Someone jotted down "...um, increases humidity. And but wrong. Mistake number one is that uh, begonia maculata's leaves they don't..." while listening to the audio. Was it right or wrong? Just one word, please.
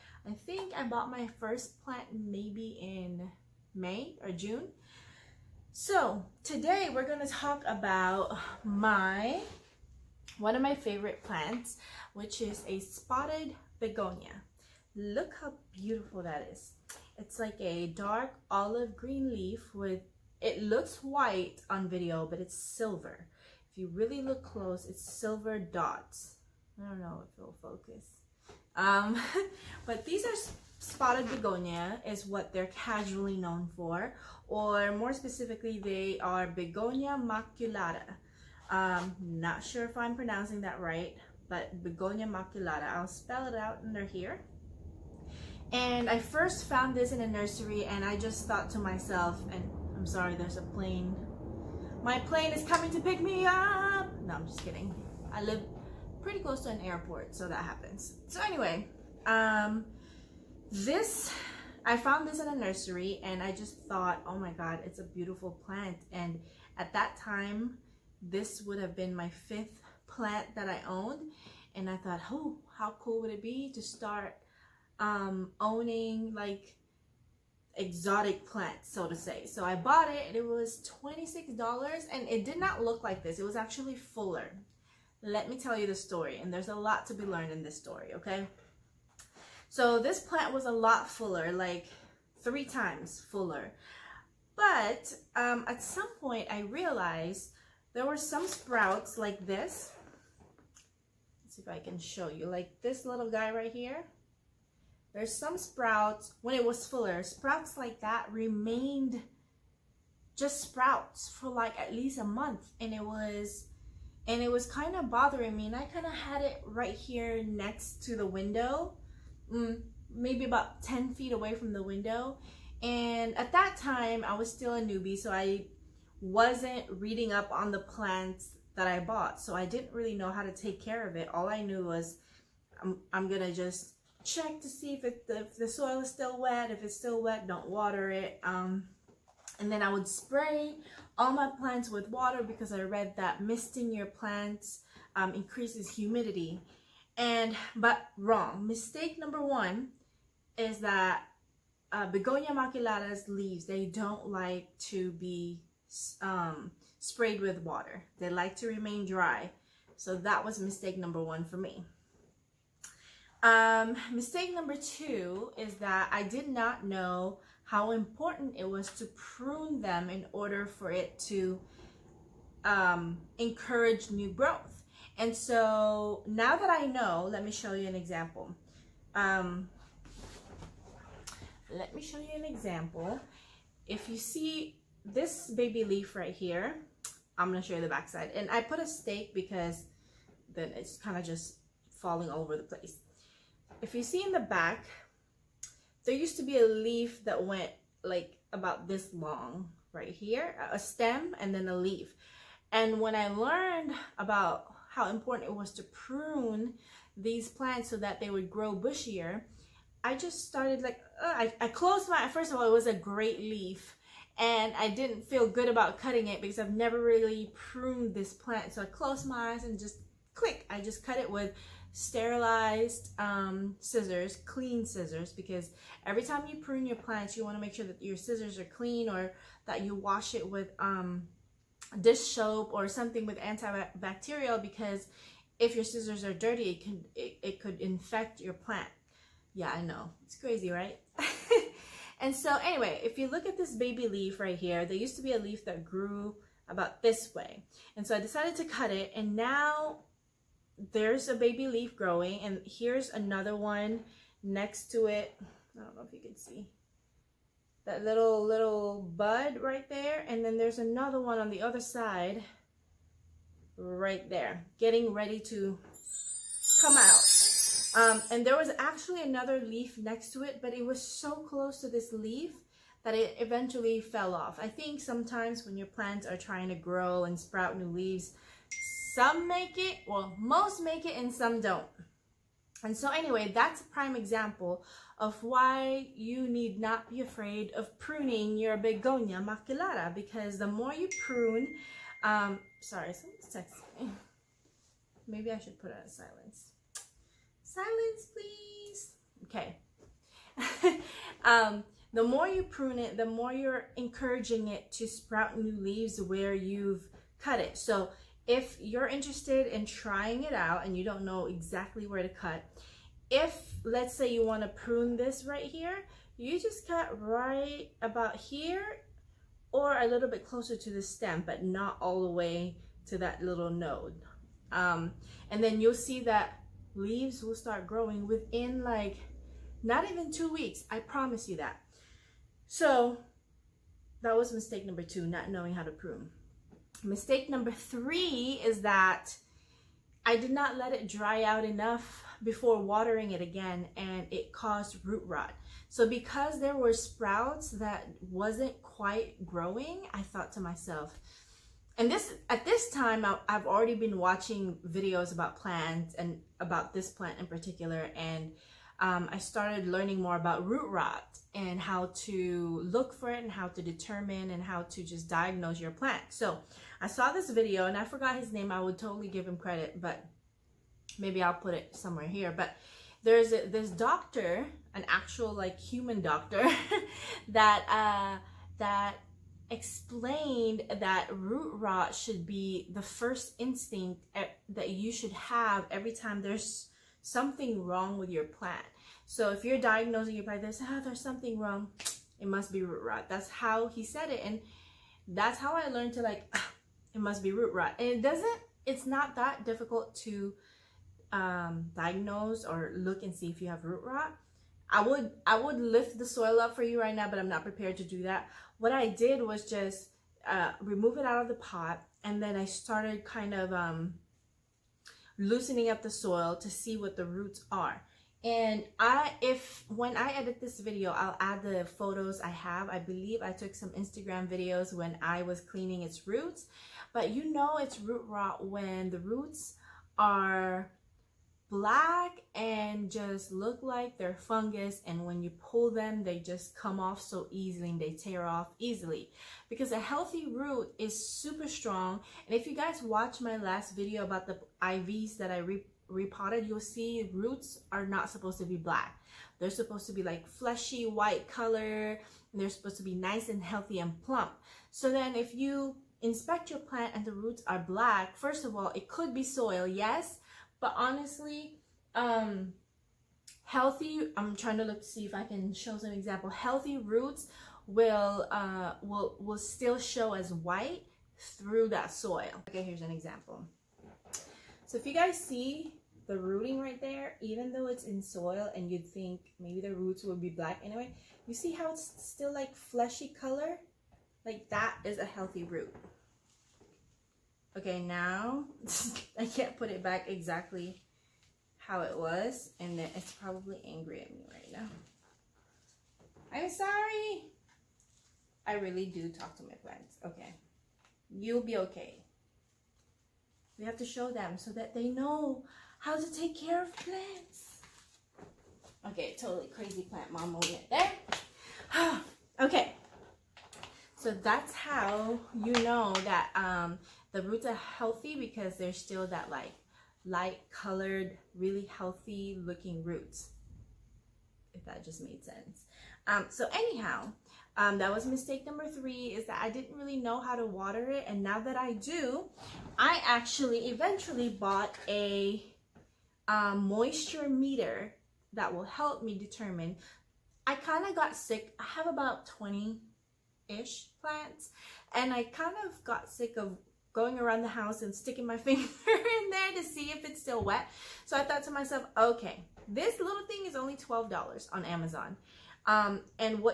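right.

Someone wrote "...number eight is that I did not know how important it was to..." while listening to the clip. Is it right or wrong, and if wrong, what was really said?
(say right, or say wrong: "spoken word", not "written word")
wrong: "two", not "eight".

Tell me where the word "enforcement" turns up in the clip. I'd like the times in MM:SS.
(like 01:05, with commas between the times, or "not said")
not said.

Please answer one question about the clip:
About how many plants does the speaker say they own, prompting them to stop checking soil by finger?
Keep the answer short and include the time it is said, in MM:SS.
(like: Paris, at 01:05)
20, at 09:02.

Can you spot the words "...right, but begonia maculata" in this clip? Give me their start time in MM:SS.
00:40.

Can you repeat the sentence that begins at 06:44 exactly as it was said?
I would, I would lift the soil up for you right now, but I'm not prepared to do that.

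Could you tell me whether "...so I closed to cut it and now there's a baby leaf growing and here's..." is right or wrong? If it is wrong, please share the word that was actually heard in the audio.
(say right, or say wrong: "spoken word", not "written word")
wrong: "decided", not "closed".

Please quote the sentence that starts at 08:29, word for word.
Okay, totally crazy plant mom moment there.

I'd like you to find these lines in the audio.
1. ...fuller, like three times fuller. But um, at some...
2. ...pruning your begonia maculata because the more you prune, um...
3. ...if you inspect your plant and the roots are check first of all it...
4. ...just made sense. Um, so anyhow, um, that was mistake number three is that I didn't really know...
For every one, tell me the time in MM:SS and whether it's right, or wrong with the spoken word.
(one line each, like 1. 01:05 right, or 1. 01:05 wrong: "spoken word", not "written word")
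1. 01:31 right
2. 04:47 right
3. 07:35 wrong: "black", not "check"
4. 08:45 right.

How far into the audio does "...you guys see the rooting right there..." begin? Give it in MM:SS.
07:55.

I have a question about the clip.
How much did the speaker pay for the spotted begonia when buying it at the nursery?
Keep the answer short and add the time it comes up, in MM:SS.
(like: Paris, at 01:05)
$26, at 01:21.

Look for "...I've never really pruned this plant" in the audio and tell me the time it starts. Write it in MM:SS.
03:36.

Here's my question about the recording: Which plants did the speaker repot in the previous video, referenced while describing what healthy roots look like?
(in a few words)
Ivies.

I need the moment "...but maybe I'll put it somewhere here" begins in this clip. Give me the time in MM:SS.
06:09.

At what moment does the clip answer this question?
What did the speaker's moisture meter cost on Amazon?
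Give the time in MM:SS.
09:13.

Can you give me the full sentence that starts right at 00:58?
So anyway, um, this, I found this in a nursery and I just thought, oh my God, it's a beautiful plant.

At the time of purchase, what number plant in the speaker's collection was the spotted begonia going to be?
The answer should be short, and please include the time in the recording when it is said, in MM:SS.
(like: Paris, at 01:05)
Fifth, at 01:09.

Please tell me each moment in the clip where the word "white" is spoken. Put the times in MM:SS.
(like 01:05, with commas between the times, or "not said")
00:21, 07:31, 07:50.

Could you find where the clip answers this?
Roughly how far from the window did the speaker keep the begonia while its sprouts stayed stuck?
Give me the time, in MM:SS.
02:00.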